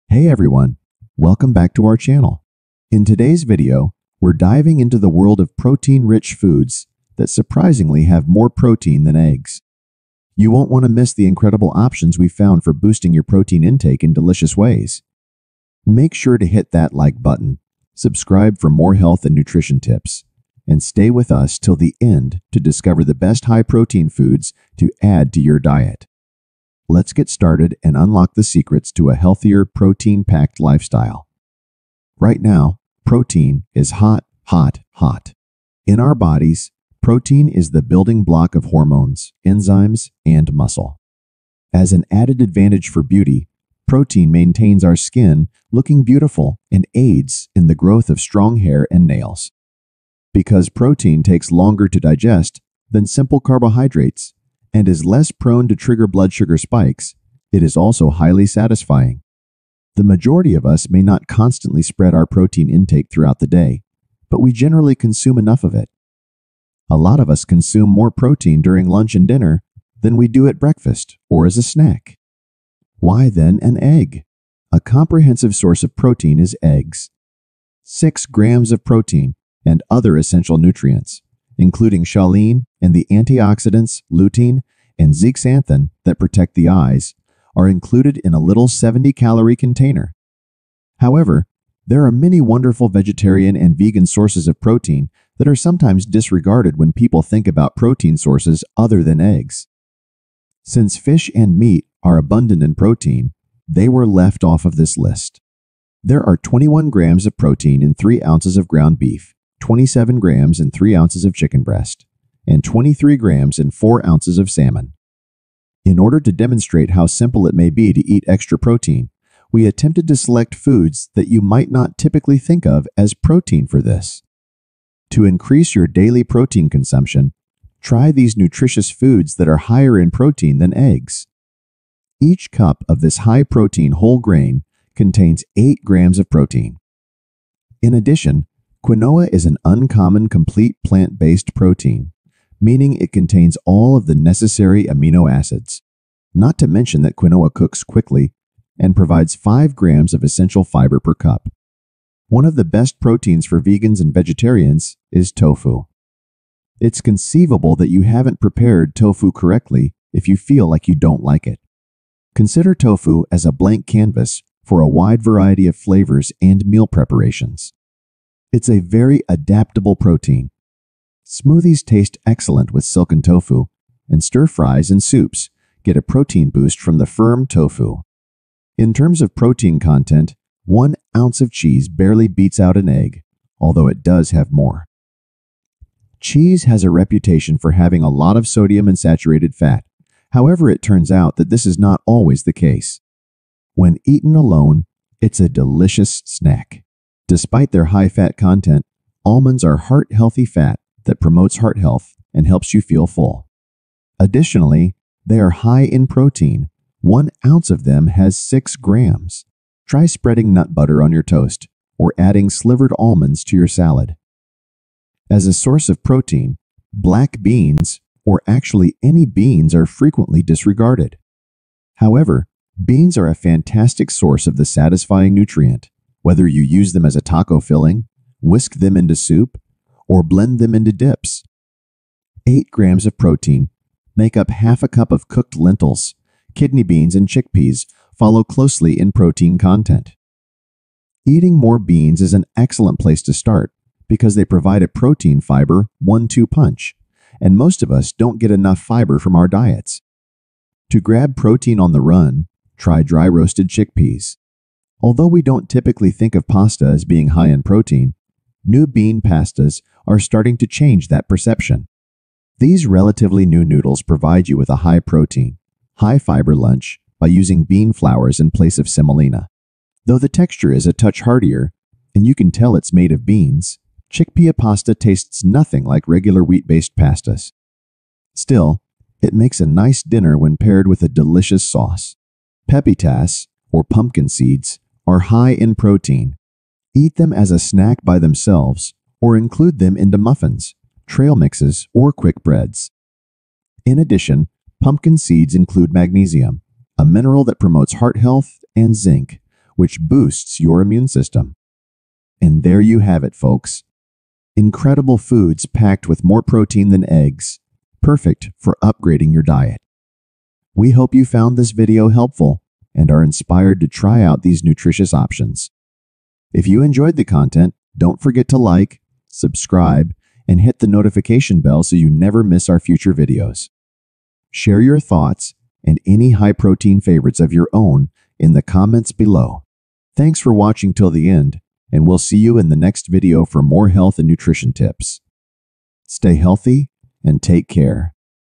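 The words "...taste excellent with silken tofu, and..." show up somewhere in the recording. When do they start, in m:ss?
2:51.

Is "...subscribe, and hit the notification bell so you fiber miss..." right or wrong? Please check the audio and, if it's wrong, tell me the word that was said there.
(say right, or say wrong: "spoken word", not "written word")
wrong: "never", not "fiber".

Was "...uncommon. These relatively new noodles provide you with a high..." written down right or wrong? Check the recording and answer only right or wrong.
wrong.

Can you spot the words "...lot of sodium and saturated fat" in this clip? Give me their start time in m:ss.
3:08.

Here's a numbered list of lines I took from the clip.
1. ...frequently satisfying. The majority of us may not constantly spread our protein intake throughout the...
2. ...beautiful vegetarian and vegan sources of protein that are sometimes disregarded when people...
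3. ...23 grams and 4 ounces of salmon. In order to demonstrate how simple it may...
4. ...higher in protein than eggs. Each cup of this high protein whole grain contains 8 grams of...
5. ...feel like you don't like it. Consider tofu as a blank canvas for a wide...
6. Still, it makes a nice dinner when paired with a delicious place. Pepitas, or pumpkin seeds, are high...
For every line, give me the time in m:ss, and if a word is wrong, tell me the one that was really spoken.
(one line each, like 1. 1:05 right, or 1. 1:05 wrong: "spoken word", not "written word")
1. 0:58 wrong: "highly", not "frequently"
2. 1:32 wrong: "wonderful", not "beautiful"
3. 1:52 right
4. 2:09 right
5. 2:40 right
6. 4:38 wrong: "sauce", not "place".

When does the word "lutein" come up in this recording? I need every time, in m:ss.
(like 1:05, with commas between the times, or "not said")
1:24.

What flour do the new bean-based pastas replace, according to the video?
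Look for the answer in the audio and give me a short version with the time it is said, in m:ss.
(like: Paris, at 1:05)
semolina, at 4:28.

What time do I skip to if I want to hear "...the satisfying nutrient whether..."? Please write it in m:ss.
3:44.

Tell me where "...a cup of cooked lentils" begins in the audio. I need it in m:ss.
3:54.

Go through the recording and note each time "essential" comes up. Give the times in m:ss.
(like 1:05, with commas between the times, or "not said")
1:20, 2:30.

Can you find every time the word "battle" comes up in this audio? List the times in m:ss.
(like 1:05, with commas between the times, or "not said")
not said.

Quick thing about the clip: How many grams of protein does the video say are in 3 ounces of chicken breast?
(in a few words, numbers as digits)
27 grams.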